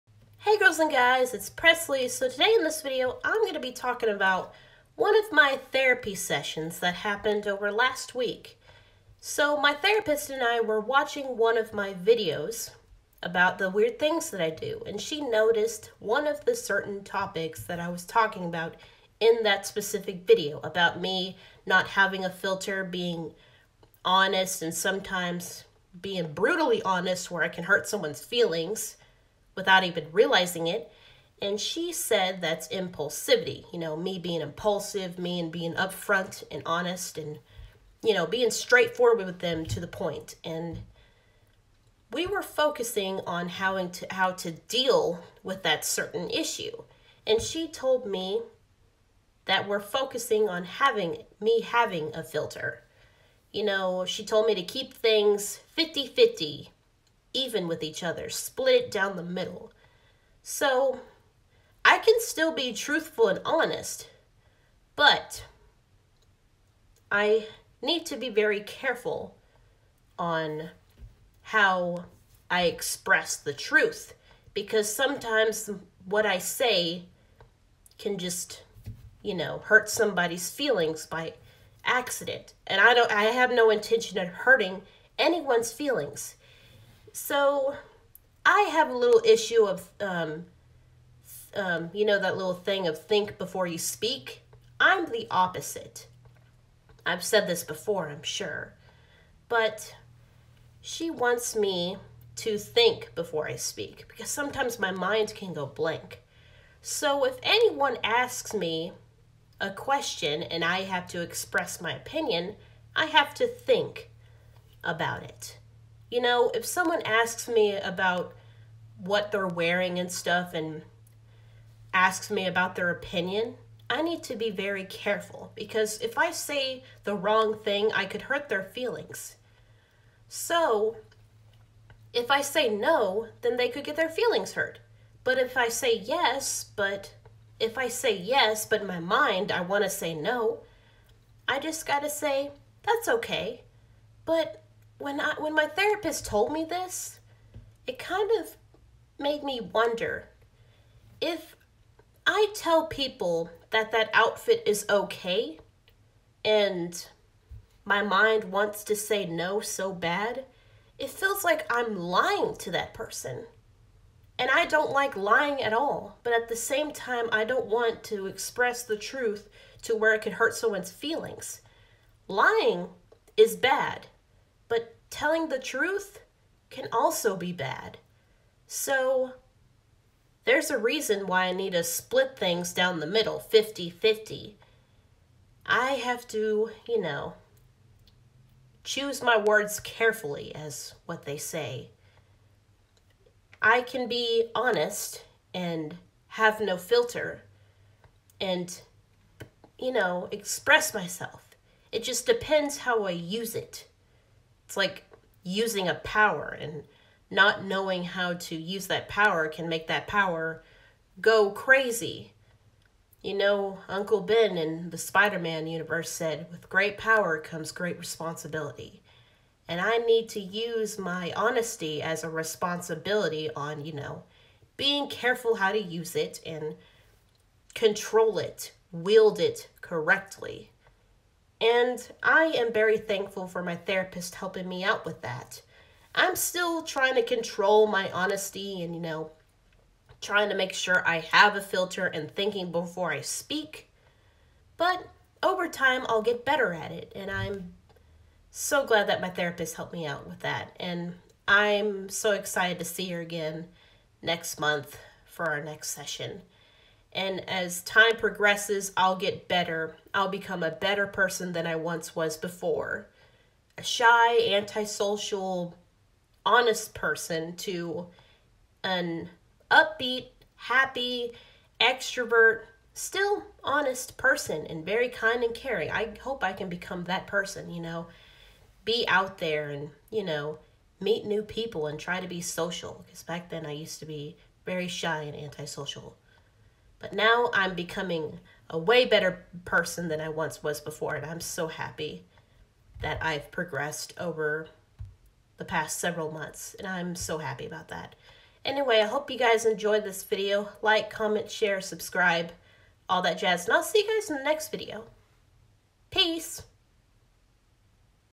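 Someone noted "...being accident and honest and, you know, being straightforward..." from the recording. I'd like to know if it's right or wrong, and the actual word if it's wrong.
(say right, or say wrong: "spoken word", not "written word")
wrong: "upfront", not "accident".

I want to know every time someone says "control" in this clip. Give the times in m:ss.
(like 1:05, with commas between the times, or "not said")
3:47, 3:57.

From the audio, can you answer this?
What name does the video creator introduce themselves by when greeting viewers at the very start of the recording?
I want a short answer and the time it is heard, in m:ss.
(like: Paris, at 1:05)
Presley, at 0:01.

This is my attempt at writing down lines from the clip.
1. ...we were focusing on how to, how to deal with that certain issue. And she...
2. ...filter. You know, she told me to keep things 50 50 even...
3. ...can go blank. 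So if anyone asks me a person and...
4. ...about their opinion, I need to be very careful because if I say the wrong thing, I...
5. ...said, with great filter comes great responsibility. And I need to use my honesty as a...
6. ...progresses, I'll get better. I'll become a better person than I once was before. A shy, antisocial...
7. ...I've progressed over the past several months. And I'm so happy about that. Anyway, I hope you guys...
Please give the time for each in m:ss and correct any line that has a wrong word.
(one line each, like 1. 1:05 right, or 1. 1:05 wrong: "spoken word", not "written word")
1. 0:42 right
2. 0:52 right
3. 1:45 wrong: "question", not "person"
4. 2:02 right
5. 3:36 wrong: "power", not "filter"
6. 4:18 right
7. 4:53 right.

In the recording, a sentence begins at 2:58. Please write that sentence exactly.
So, there's a reason why I need to split things down the middle 50 50.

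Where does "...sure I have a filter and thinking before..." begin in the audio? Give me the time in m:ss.
4:00.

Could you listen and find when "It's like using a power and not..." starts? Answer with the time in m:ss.
3:24.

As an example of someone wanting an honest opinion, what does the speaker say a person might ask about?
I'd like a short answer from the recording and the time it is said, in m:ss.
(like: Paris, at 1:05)
what they're wearing, at 1:58.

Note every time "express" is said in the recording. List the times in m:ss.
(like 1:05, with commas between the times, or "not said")
1:12, 1:51, 2:48, 3:20.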